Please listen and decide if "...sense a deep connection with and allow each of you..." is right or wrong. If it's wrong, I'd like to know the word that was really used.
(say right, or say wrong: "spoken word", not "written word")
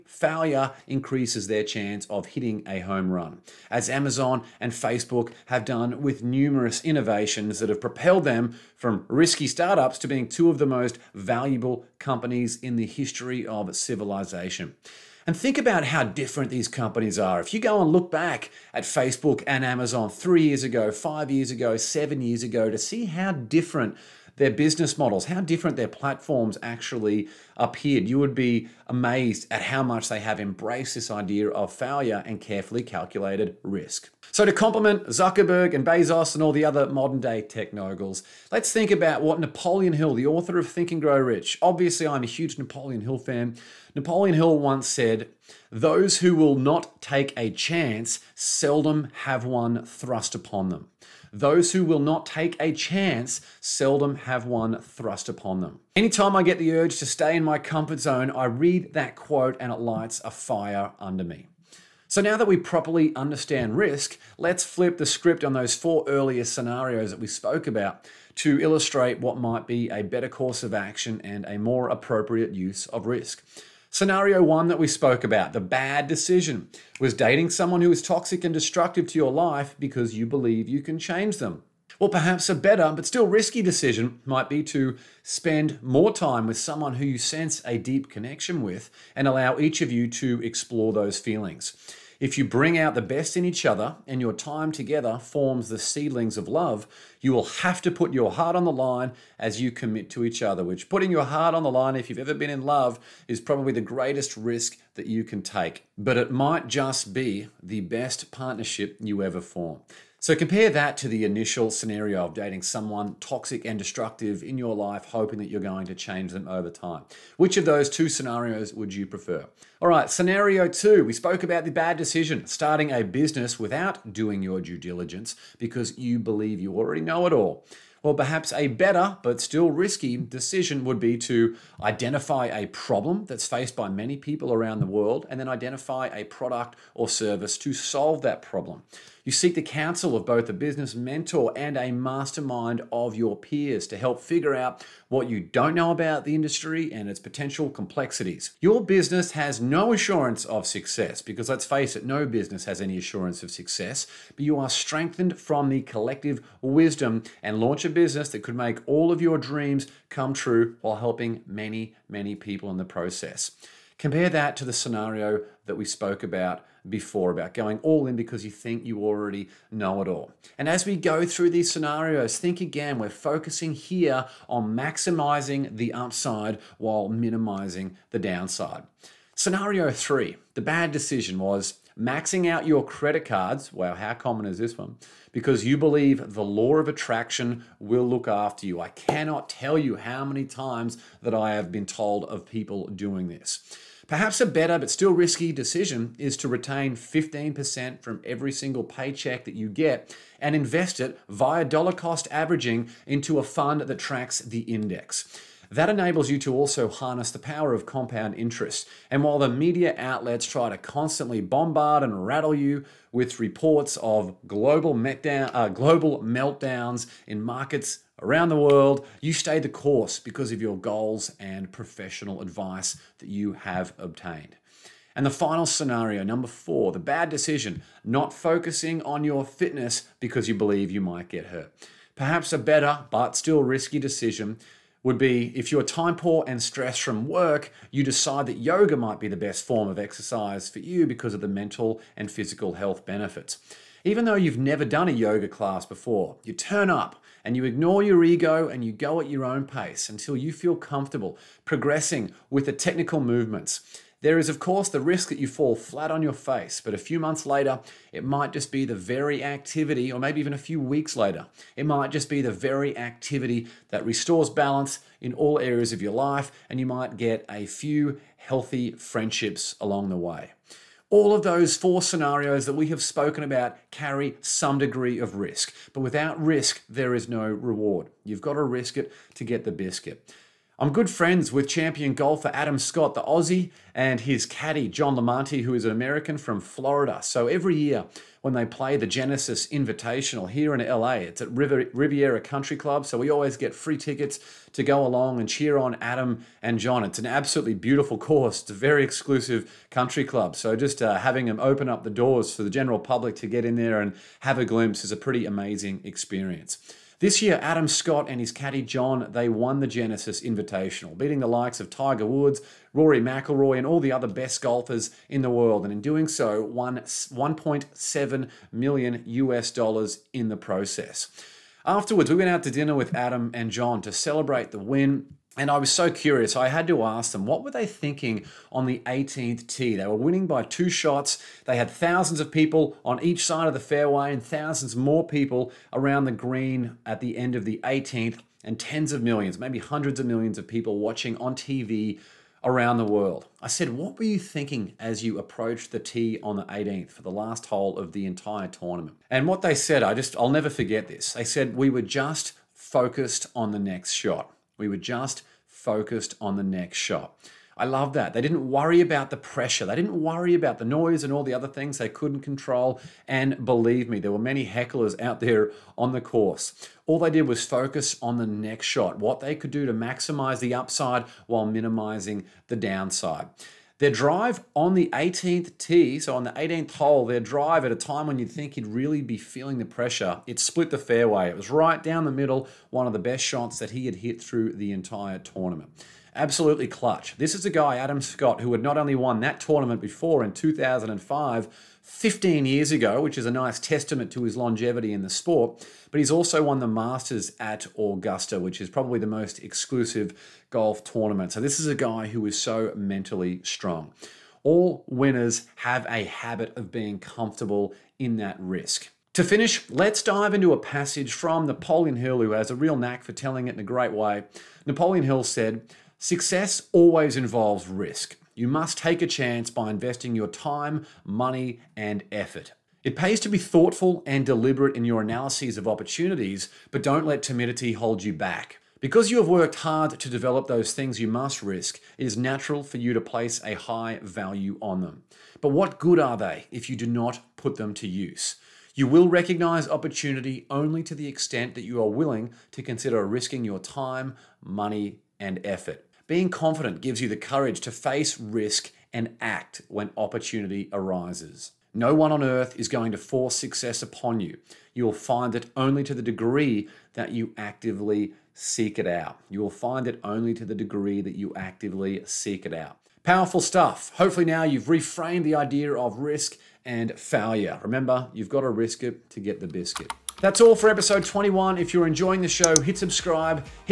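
right.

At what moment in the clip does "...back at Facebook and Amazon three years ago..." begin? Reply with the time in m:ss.
0:18.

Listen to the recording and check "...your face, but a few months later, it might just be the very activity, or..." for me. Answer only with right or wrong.
right.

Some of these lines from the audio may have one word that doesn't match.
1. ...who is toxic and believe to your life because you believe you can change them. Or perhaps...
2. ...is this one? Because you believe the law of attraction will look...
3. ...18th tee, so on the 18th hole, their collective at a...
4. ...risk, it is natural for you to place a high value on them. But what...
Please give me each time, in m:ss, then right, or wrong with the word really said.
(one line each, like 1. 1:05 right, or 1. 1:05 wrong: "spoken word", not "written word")
1. 1:17 wrong: "destructive", not "believe"
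2. 3:04 right
3. 6:15 wrong: "drive", not "collective"
4. 7:11 right.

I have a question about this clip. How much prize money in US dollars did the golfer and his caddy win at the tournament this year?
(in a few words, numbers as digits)
1.7 million US dollars.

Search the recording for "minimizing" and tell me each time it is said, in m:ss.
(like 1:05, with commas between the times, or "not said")
2:57, 6:11.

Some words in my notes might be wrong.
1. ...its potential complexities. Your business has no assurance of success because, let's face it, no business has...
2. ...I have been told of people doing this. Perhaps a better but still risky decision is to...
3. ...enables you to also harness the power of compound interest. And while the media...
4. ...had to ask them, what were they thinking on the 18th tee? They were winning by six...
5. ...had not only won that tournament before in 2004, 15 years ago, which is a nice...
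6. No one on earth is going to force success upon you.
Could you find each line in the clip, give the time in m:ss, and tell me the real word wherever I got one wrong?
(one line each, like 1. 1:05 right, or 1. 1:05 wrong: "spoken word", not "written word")
1. 2:27 right
2. 3:11 right
3. 3:25 right
4. 5:26 wrong: "two", not "six"
5. 6:28 wrong: "2005", not "2004"
6. 7:31 right.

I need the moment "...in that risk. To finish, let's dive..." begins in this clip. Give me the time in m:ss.
6:48.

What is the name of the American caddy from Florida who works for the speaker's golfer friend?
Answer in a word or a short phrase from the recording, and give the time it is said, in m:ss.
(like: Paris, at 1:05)
John Lamonti, at 4:44.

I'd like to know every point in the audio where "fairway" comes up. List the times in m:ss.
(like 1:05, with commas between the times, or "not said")
5:33, 6:20.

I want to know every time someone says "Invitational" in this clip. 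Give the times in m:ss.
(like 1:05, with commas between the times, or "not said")
4:49, 5:10.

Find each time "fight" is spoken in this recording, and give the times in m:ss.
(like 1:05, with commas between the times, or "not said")
not said.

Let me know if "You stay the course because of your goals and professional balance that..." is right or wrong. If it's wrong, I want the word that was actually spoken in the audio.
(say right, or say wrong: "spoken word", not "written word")
wrong: "advice", not "balance".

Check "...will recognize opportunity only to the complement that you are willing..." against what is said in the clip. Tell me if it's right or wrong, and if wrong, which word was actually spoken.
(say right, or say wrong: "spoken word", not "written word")
wrong: "extent", not "complement".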